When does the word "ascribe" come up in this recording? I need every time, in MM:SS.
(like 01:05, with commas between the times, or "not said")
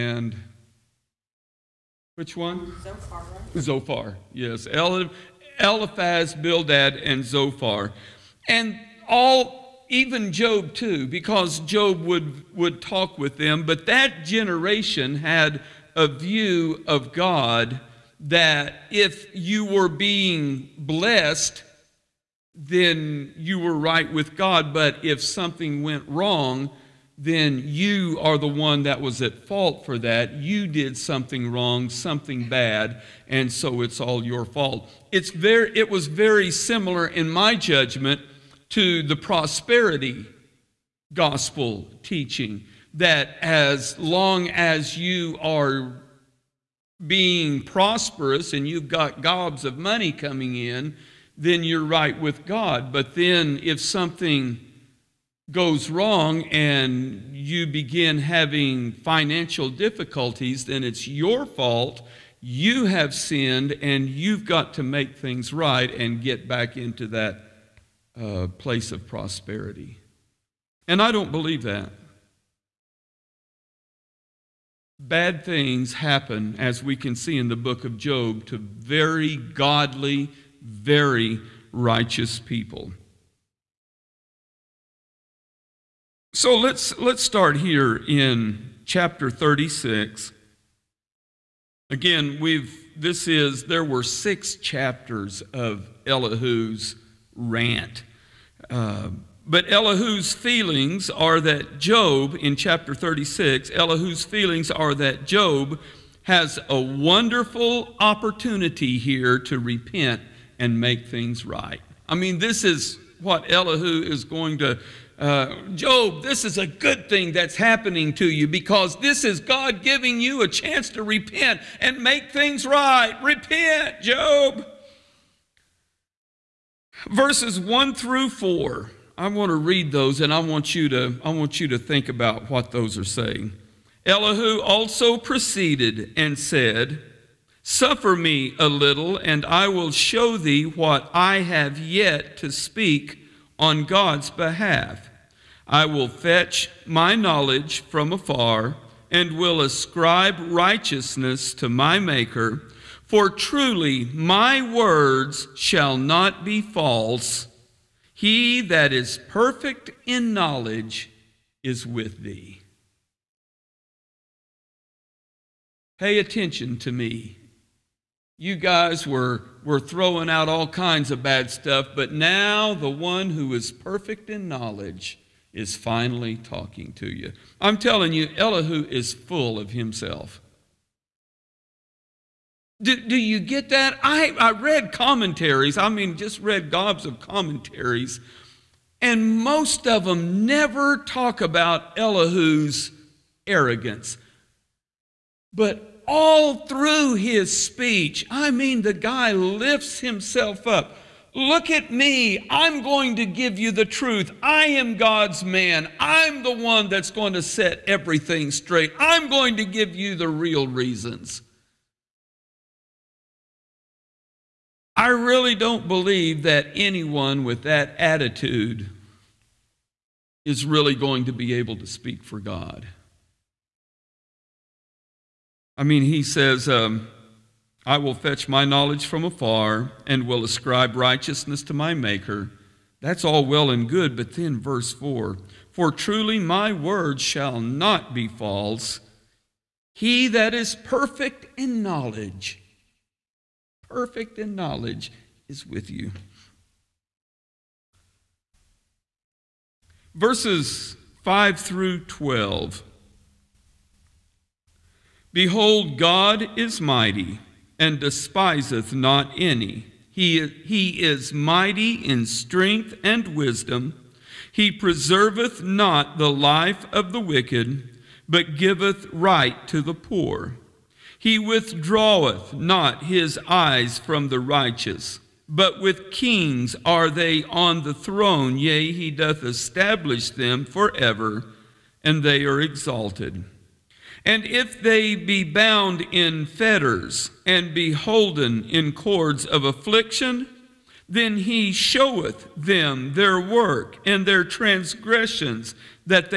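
02:29, 03:50.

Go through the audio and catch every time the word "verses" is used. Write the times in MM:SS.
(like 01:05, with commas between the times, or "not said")
02:07, 03:54, 04:10.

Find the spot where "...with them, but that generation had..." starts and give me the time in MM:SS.
00:13.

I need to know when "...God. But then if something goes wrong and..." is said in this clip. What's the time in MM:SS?
00:52.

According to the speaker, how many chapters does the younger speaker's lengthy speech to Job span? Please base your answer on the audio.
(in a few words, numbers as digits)
6.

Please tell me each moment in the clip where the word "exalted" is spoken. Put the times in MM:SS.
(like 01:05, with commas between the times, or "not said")
04:42.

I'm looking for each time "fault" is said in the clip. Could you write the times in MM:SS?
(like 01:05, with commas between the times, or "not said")
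00:29, 00:34, 01:01.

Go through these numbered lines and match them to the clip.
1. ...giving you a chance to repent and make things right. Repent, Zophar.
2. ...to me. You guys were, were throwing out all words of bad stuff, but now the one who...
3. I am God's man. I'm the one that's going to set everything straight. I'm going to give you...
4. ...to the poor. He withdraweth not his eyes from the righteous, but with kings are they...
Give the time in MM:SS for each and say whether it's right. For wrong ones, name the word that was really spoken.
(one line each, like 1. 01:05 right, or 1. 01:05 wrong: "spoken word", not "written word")
1. 01:59 wrong: "Job", not "Zophar"
2. 02:46 wrong: "kinds", not "words"
3. 03:24 right
4. 04:29 right.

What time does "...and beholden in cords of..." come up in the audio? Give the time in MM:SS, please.
04:47.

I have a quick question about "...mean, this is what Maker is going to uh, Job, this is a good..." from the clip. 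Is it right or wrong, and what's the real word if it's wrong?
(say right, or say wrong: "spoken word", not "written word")
wrong: "Elihu", not "Maker".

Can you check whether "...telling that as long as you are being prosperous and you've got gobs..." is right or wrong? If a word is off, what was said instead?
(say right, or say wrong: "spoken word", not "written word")
wrong: "teaching", not "telling".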